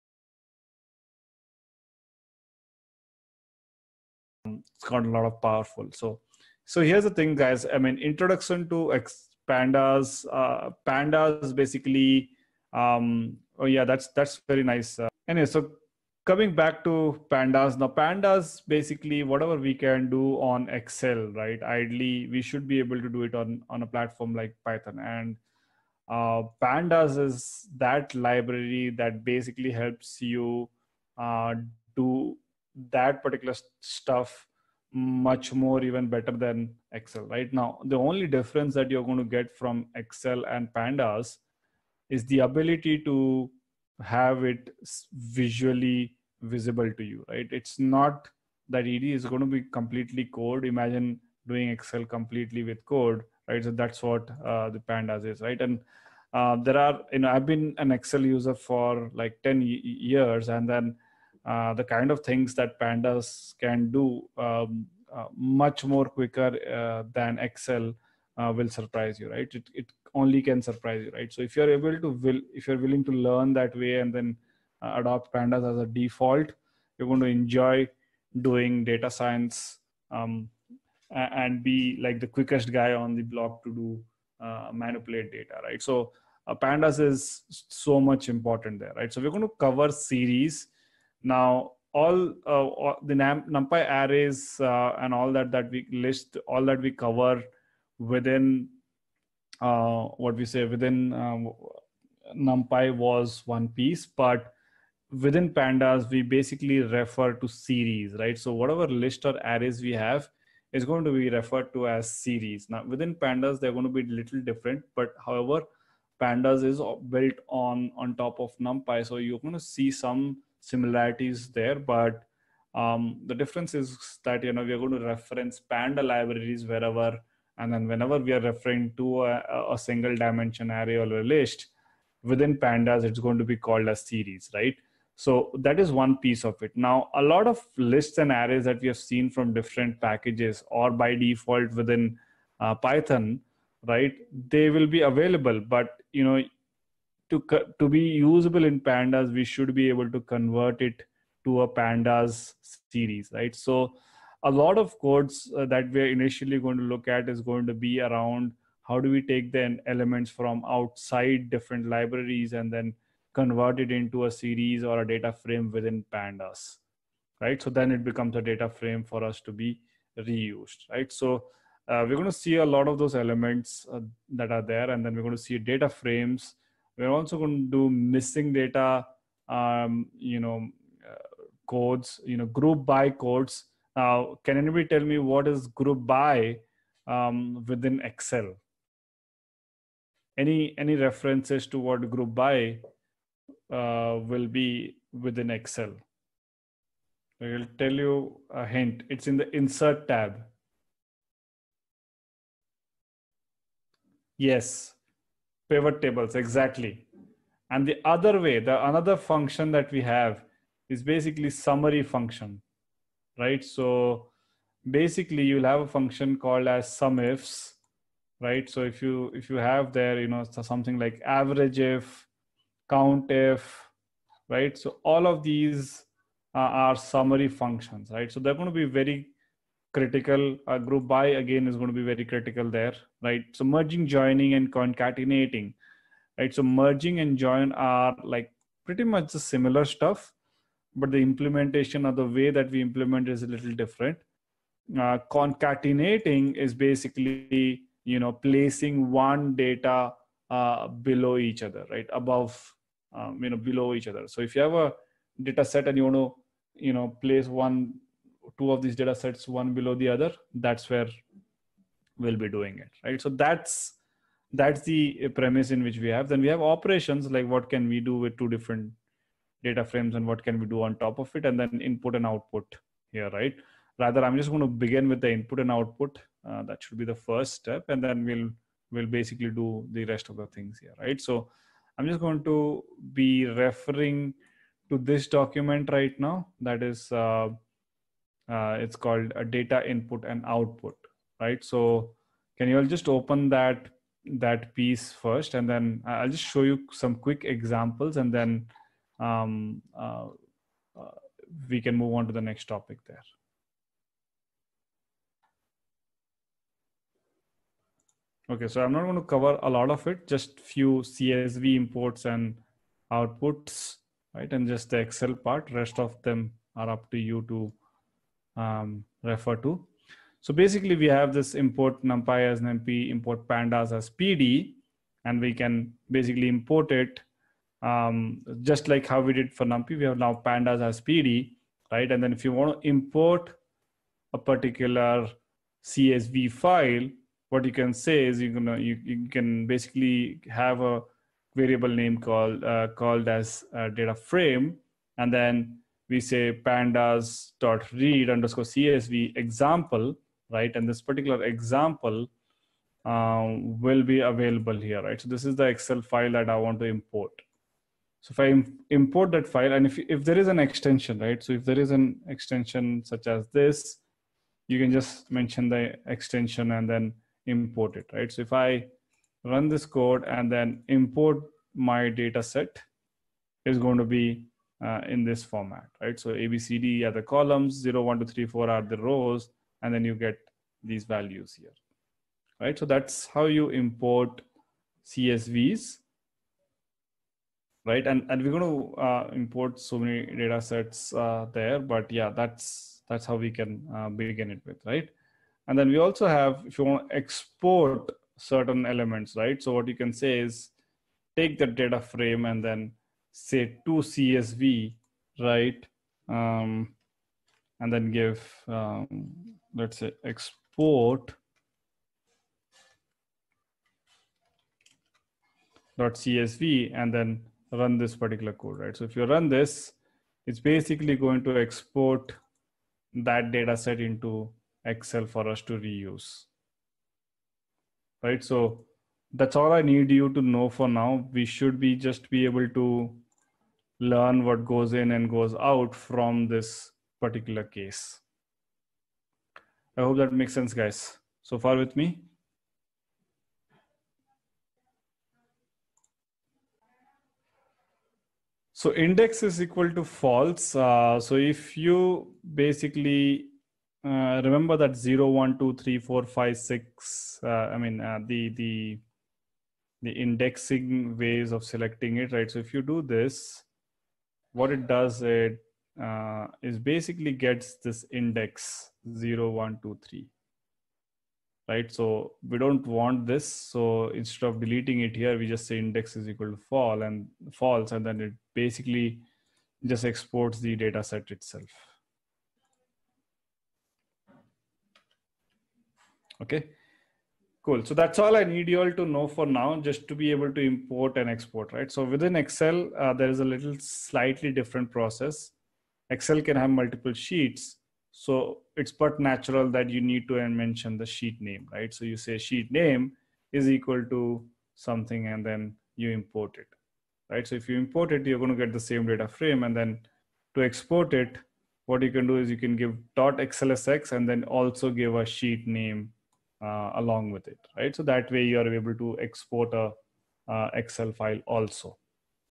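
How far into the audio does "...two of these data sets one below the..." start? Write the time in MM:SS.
04:18.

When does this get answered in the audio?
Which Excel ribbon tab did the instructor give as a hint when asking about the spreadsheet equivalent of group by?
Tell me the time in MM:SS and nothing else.
03:19.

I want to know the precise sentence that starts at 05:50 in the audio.
And this particular example um, will be available here, right?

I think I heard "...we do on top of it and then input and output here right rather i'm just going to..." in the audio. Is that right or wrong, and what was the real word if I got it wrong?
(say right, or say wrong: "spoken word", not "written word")
right.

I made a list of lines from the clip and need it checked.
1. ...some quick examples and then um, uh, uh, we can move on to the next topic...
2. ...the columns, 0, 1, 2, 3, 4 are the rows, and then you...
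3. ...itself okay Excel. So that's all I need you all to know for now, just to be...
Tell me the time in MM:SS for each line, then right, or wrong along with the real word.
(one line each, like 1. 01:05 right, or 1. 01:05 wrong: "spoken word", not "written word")
1. 04:56 right
2. 06:17 right
3. 08:01 wrong: "Cool", not "Excel".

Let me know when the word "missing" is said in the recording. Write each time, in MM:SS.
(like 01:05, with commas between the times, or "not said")
02:57.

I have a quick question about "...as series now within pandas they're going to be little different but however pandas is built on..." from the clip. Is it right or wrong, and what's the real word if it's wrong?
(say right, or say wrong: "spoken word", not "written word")
right.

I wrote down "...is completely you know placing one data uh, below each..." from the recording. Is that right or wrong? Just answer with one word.
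wrong.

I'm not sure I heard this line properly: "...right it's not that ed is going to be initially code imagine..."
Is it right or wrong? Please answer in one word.
wrong.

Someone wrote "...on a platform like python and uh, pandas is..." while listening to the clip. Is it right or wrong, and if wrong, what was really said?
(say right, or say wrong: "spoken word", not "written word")
right.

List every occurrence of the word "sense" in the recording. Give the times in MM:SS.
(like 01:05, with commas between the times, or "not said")
07:20.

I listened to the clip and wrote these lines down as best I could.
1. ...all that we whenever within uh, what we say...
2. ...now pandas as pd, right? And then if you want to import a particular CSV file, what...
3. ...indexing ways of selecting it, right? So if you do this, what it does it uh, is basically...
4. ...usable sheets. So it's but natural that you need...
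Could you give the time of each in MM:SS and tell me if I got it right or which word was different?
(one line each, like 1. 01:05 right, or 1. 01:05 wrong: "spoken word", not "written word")
1. 01:36 wrong: "cover", not "whenever"
2. 05:30 right
3. 07:40 right
4. 08:16 wrong: "multiple", not "usable".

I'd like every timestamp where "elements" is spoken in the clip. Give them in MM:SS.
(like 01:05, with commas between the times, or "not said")
02:39, 02:53, 06:38.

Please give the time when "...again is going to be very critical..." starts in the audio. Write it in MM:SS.
03:51.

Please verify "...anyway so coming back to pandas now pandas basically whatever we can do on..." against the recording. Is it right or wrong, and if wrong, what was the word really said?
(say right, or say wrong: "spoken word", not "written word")
right.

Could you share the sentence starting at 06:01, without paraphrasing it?
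So if there is an extension such as this, you can just mention the extension and then import it, right?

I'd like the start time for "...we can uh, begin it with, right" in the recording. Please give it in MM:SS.
06:33.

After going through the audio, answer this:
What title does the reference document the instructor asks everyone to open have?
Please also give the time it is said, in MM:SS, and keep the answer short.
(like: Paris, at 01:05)
data input and output, at 04:49.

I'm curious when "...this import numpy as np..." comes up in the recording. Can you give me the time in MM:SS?
05:21.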